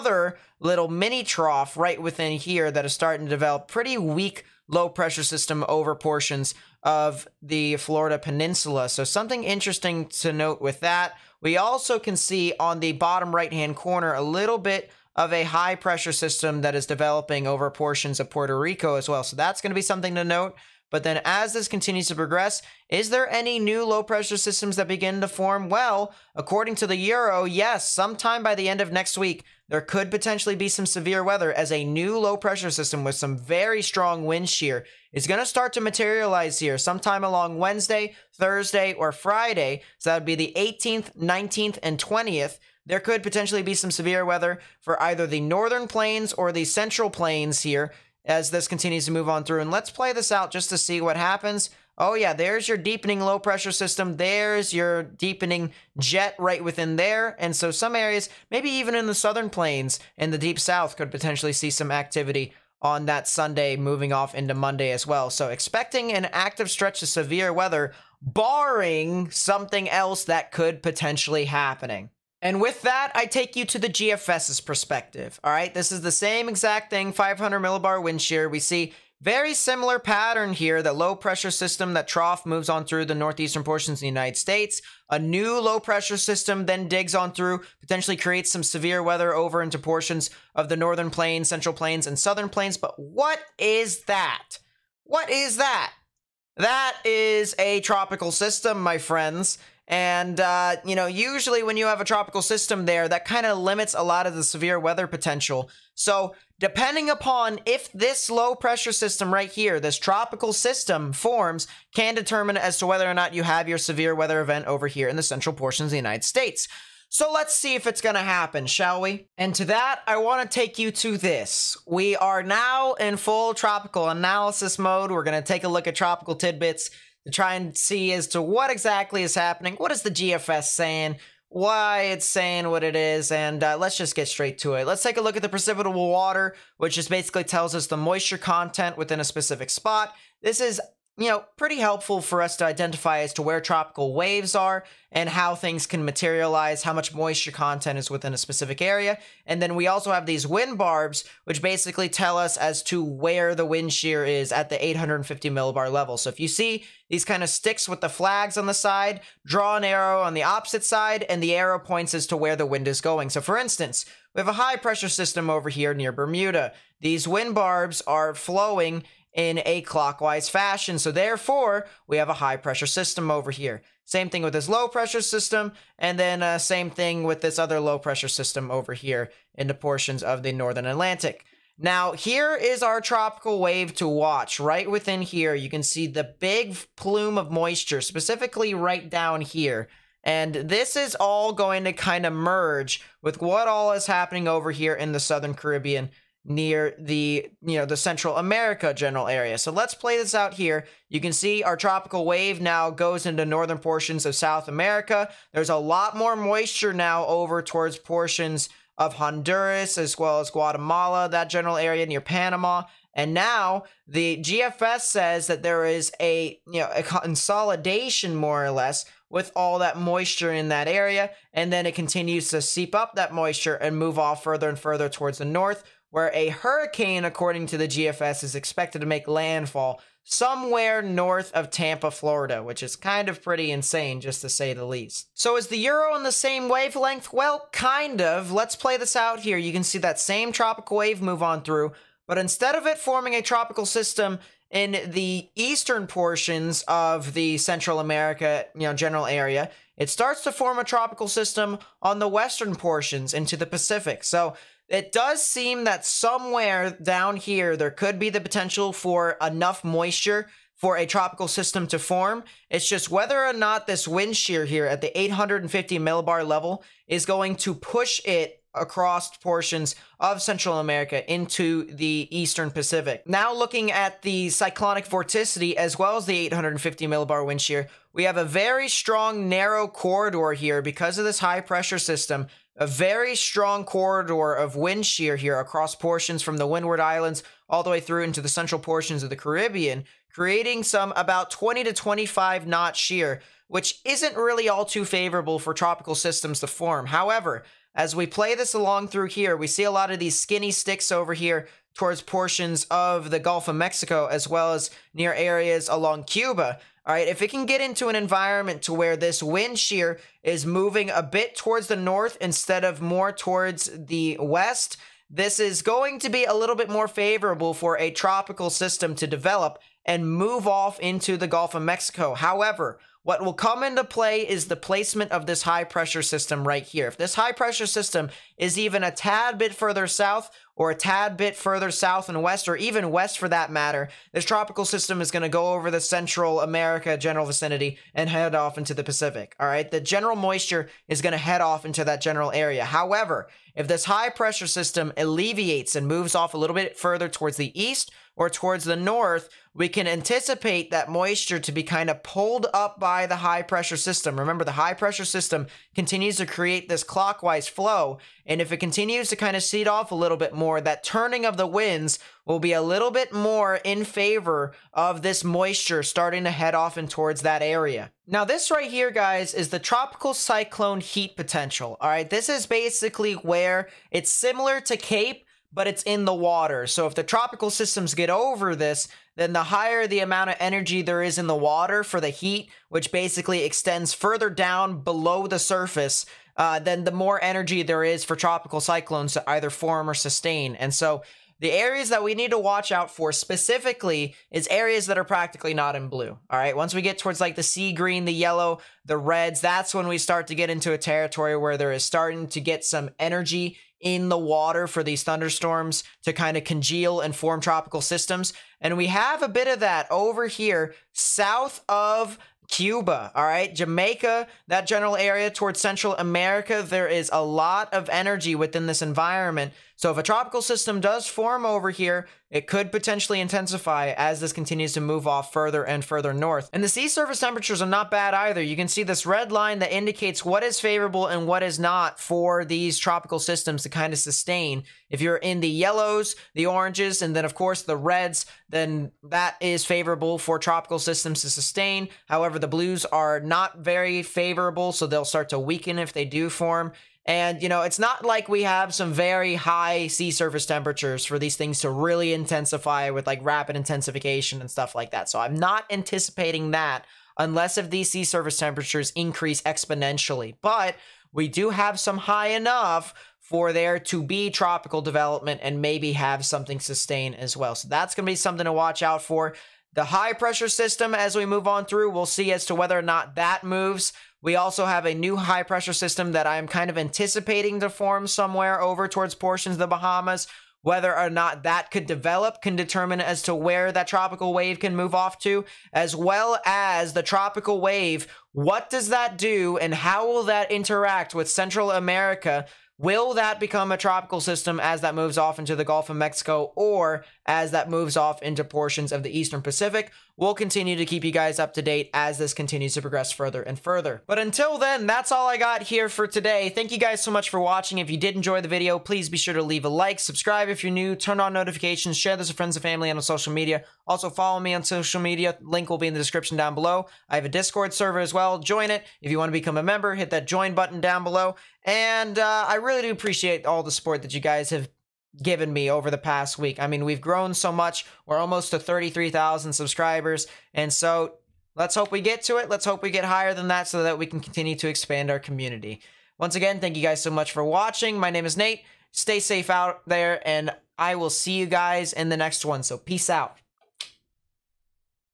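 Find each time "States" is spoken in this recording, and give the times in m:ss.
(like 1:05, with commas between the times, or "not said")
1:24, 1:56.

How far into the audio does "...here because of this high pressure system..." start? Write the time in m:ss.
4:40.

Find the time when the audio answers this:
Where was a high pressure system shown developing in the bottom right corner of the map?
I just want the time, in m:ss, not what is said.
0:18.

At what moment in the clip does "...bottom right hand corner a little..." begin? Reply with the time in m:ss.
0:12.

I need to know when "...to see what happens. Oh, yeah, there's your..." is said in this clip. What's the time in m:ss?
0:50.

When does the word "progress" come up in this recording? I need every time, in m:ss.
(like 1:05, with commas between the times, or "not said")
0:22, 8:23.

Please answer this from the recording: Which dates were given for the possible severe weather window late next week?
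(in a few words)
18th, 19th, and 20th.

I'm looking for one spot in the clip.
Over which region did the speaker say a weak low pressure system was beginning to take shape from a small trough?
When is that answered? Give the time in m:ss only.
0:07.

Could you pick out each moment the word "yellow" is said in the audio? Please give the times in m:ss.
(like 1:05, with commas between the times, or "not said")
6:38, 7:15.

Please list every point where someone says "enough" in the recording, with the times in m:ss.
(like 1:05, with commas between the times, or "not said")
4:19, 7:42.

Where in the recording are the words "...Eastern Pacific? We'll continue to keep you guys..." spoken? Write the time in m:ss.
8:19.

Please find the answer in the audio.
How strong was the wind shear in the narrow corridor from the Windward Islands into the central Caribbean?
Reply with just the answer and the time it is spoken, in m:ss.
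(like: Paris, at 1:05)
20 to 25 knots, at 4:51.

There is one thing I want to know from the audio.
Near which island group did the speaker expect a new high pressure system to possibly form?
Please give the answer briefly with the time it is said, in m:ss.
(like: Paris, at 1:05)
Bahamas, at 7:59.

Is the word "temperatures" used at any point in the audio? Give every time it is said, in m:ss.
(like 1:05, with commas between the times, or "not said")
7:07, 7:30, 7:38.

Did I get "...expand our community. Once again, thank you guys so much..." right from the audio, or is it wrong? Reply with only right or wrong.
right.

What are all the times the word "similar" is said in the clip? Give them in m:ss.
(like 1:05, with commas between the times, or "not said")
1:19, 6:14.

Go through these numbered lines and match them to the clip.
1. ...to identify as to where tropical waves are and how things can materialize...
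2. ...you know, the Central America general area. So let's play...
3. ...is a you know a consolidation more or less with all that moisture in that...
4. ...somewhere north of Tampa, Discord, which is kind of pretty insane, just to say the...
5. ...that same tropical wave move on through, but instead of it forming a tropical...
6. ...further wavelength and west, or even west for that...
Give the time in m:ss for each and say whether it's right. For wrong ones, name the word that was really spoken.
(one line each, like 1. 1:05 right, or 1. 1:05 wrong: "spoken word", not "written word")
1. 2:22 right
2. 3:17 right
3. 3:35 right
4. 3:50 wrong: "Florida", not "Discord"
5. 3:59 right
6. 5:31 wrong: "south", not "wavelength".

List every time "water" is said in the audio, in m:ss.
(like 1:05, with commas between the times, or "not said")
2:16, 6:16, 6:21, 6:44.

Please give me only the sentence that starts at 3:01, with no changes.
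Now, here is our tropical wave to watch.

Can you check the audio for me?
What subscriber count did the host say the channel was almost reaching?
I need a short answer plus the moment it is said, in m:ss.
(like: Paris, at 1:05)
33,000, at 8:48.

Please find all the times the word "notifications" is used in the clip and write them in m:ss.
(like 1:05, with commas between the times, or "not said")
8:31.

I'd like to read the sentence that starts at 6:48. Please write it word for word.
And we have a bit of that over here south of Cuba, all right, Jamaica, that general area towards Central America.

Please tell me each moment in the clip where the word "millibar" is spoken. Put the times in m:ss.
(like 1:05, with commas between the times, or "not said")
1:17, 2:35, 4:25, 4:37.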